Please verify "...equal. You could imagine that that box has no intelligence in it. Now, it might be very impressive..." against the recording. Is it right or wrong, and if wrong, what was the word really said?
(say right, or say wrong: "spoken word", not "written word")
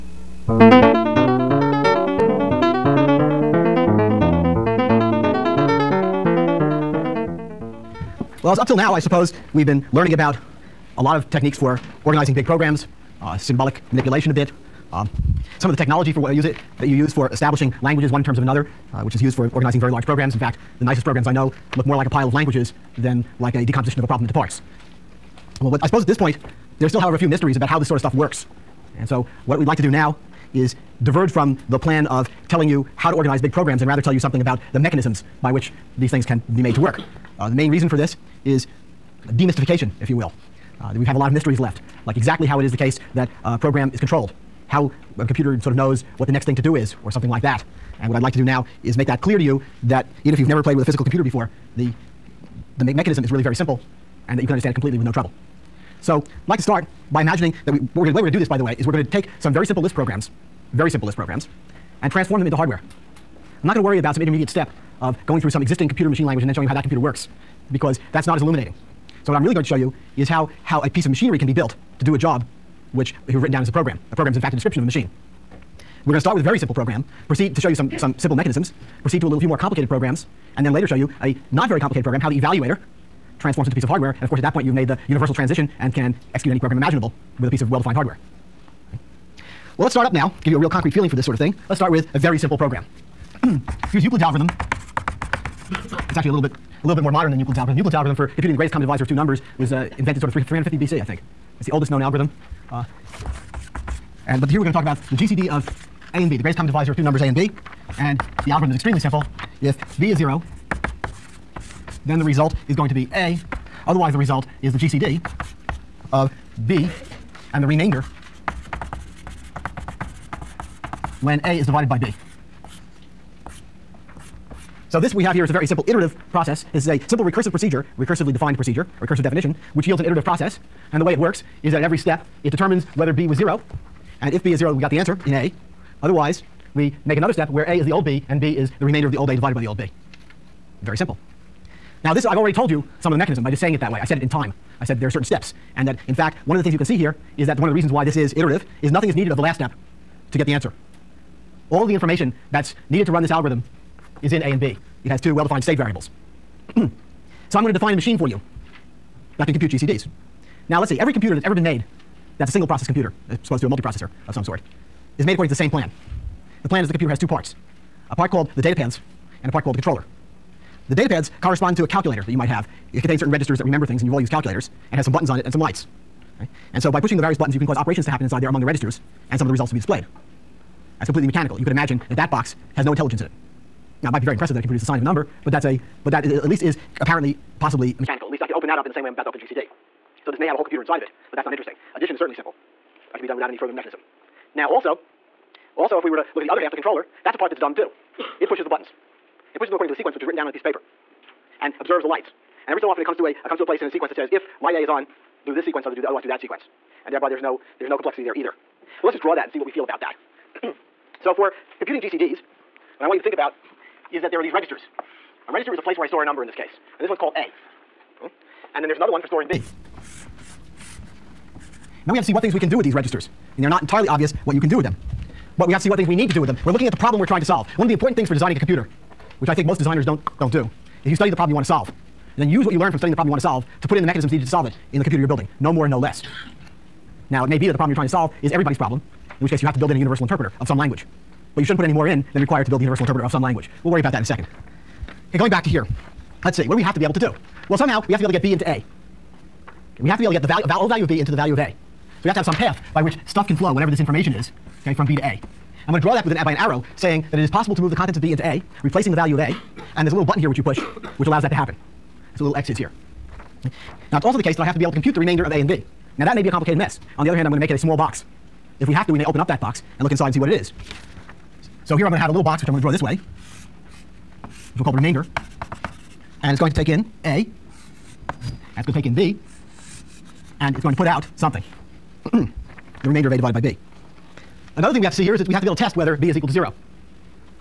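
wrong: "mechanical", not "equal".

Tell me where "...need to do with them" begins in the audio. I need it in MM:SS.
03:46.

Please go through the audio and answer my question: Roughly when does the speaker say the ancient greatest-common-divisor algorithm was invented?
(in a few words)
350 BC.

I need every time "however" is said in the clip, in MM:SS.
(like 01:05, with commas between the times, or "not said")
00:26.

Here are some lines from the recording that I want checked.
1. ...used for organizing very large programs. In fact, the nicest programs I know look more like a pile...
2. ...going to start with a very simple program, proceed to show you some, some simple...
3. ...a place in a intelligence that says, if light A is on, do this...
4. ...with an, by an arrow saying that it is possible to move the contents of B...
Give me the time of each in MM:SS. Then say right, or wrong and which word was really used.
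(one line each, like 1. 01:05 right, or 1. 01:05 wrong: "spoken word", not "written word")
1. 00:19 right
2. 01:16 right
3. 03:23 wrong: "sequence", not "intelligence"
4. 04:16 right.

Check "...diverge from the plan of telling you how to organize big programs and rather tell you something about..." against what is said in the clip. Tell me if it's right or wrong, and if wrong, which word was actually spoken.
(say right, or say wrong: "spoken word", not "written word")
right.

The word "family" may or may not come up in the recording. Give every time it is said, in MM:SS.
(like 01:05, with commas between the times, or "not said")
not said.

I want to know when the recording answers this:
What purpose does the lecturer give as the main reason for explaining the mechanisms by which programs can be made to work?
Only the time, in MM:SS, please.
00:39.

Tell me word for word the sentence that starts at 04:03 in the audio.
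We'll worry about that in a second.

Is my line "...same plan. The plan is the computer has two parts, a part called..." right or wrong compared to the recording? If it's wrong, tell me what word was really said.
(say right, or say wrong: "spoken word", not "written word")
right.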